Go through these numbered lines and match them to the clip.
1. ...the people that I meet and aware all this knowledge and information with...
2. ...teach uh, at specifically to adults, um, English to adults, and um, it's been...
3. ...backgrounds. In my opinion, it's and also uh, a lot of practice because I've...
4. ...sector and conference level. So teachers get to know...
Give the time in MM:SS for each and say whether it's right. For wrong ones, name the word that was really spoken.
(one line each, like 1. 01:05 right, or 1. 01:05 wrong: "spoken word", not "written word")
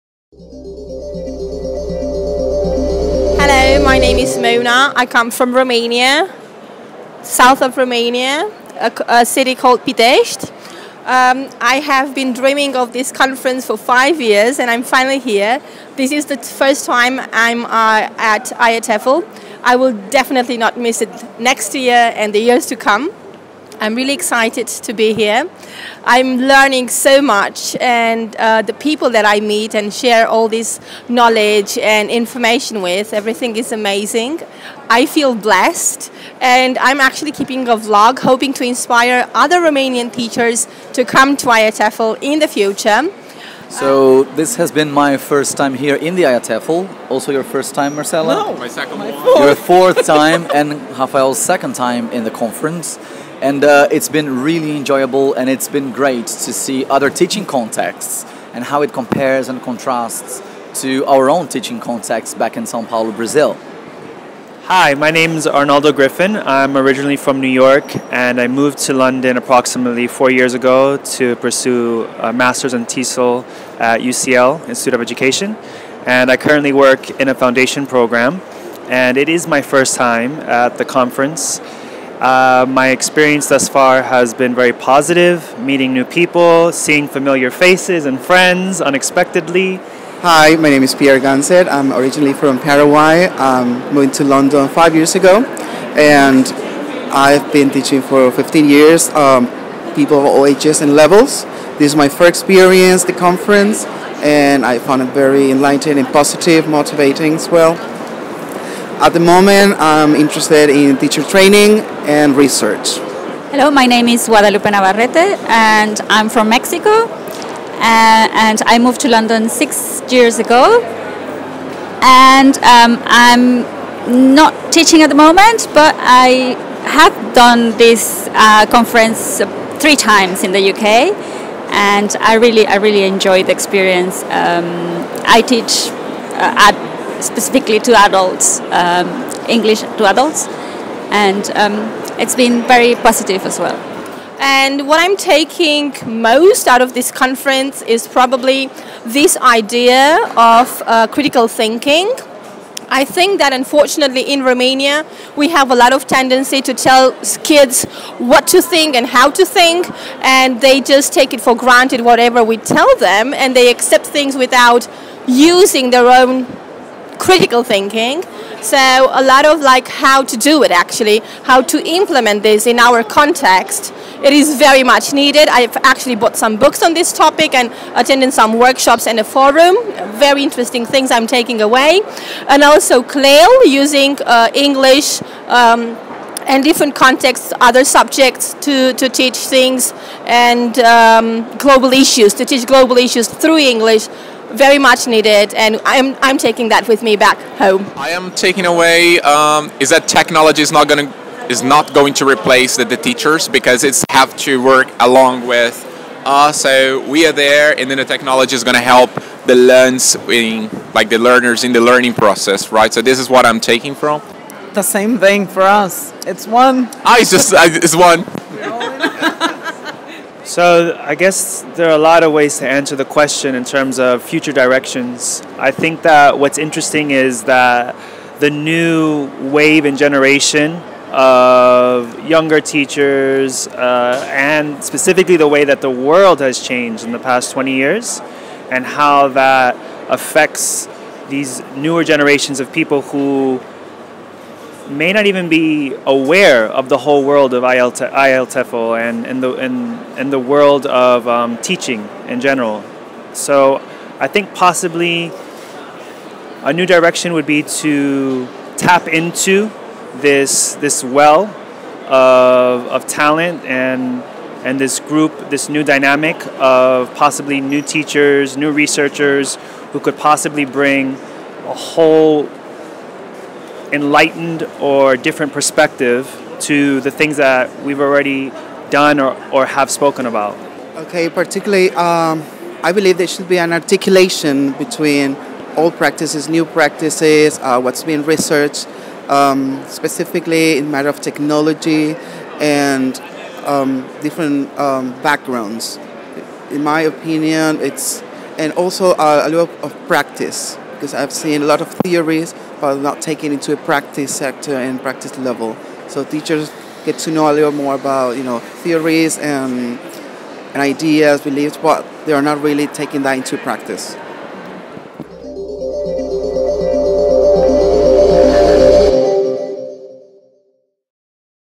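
1. 00:28 wrong: "share", not "aware"
2. 02:15 right
3. 04:55 right
4. 05:04 wrong: "practice", not "conference".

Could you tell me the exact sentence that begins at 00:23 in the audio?
I'm really excited to be here.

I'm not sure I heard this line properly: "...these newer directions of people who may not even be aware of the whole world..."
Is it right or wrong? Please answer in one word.
wrong.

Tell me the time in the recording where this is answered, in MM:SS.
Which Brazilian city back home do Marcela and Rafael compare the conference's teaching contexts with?
01:02.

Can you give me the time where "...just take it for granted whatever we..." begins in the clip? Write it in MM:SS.
02:40.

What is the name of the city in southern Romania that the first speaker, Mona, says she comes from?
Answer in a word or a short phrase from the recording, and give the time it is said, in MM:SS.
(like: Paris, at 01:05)
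Pitești, at 00:09.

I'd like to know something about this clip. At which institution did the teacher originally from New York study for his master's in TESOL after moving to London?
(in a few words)
UCL, Institute of Education.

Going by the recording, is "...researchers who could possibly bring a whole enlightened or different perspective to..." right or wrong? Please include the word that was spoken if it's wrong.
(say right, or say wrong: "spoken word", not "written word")
right.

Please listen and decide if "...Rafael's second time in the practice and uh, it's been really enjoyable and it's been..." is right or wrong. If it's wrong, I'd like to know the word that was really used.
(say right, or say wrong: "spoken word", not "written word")
wrong: "conference", not "practice".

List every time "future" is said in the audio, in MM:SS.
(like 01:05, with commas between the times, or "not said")
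00:42, 03:44.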